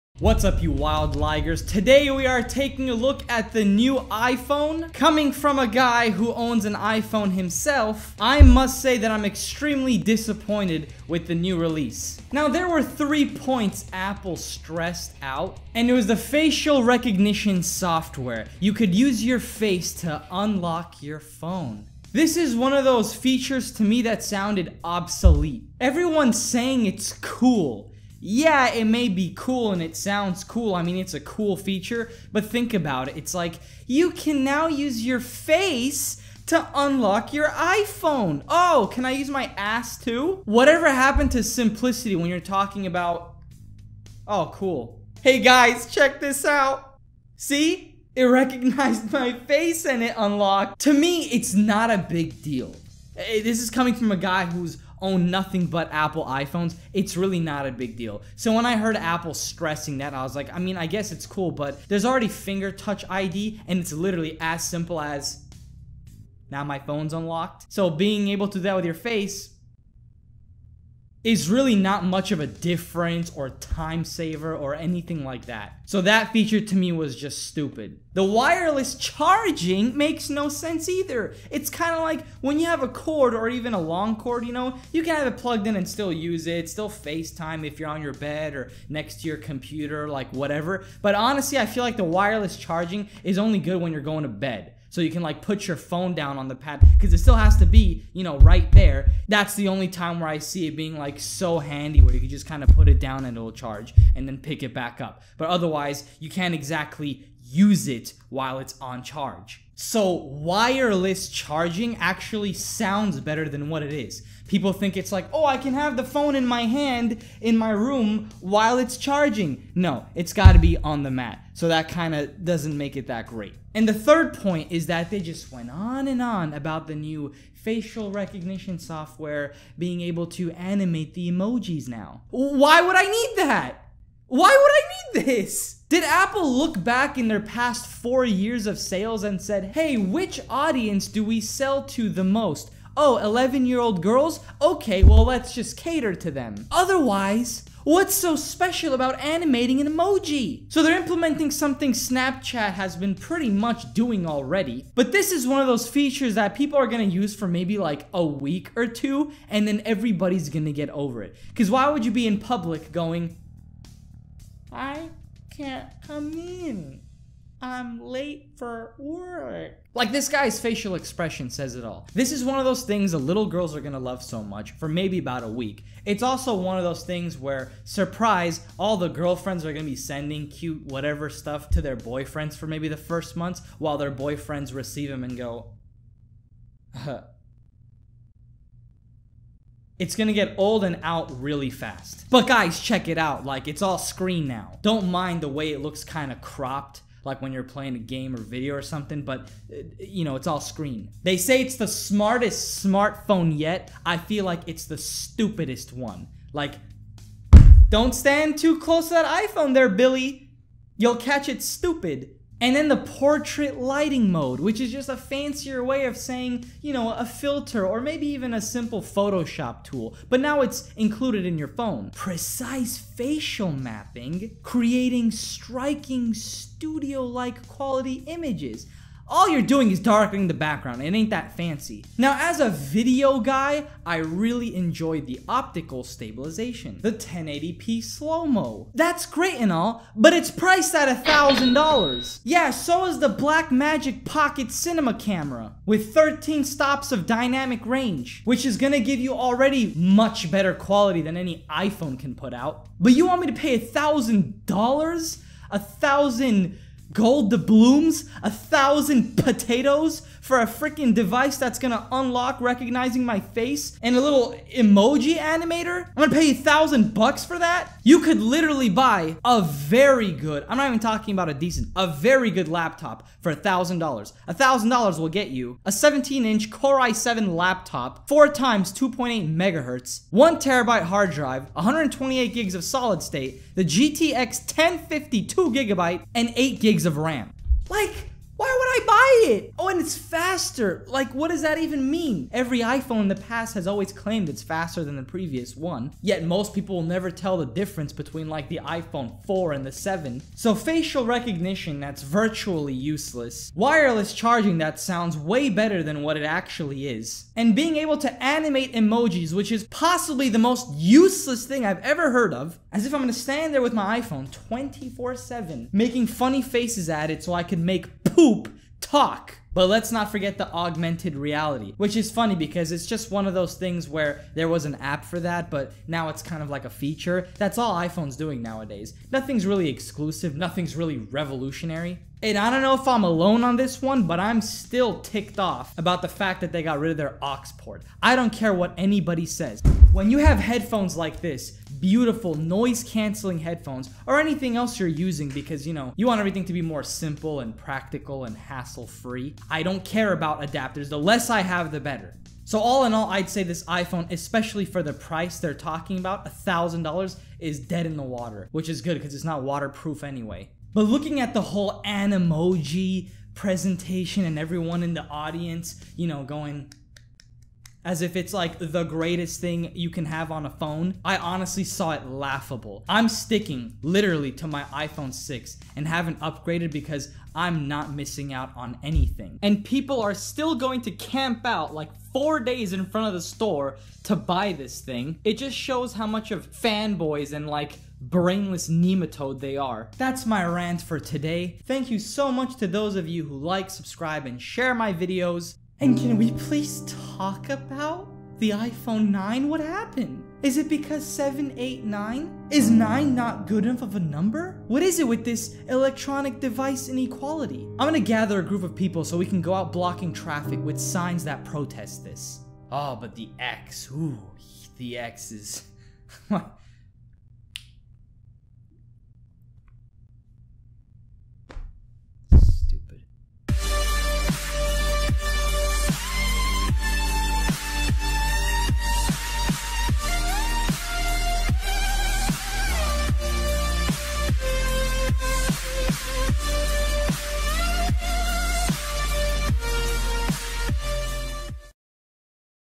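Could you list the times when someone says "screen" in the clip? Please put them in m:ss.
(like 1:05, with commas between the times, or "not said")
3:13, 3:20.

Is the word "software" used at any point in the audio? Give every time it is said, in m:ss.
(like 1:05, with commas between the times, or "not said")
0:17, 2:08.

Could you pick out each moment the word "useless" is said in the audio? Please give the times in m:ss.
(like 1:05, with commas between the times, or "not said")
5:02, 5:10.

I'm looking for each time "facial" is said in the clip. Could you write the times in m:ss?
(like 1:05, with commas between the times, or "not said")
0:16, 2:07, 2:50, 3:42, 5:00.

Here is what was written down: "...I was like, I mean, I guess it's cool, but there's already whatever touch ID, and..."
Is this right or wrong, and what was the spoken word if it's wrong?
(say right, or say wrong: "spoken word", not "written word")
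wrong: "finger", not "whatever".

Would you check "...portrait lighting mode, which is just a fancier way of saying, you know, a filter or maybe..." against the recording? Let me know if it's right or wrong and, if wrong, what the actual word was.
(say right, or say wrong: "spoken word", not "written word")
right.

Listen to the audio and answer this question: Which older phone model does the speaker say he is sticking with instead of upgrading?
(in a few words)
iPhone 6.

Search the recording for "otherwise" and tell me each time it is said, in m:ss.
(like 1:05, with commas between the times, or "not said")
1:45, 2:26.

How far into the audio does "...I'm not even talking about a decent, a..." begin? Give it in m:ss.
4:30.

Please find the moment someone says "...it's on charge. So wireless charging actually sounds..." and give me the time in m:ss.
1:48.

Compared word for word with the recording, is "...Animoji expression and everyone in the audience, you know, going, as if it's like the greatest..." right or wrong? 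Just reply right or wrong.
wrong.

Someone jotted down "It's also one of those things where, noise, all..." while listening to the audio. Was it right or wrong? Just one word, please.
wrong.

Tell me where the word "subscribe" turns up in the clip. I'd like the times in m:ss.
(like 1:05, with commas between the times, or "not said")
6:33.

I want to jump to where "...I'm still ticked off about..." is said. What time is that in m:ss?
5:34.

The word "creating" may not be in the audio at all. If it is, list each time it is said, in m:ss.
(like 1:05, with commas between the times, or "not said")
3:44.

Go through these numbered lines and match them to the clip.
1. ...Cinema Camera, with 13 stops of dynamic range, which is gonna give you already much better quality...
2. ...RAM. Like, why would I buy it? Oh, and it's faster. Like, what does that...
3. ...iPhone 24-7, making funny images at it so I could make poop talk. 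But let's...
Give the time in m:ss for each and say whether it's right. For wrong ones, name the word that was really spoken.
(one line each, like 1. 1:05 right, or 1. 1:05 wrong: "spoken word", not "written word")
1. 4:04 right
2. 4:47 right
3. 5:14 wrong: "faces", not "images".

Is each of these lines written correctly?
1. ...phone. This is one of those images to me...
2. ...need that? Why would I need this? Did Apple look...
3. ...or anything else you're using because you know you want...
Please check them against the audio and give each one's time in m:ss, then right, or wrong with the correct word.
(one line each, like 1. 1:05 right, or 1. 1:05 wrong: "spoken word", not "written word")
1. 0:21 wrong: "features", not "images"
2. 2:13 right
3. 5:44 right.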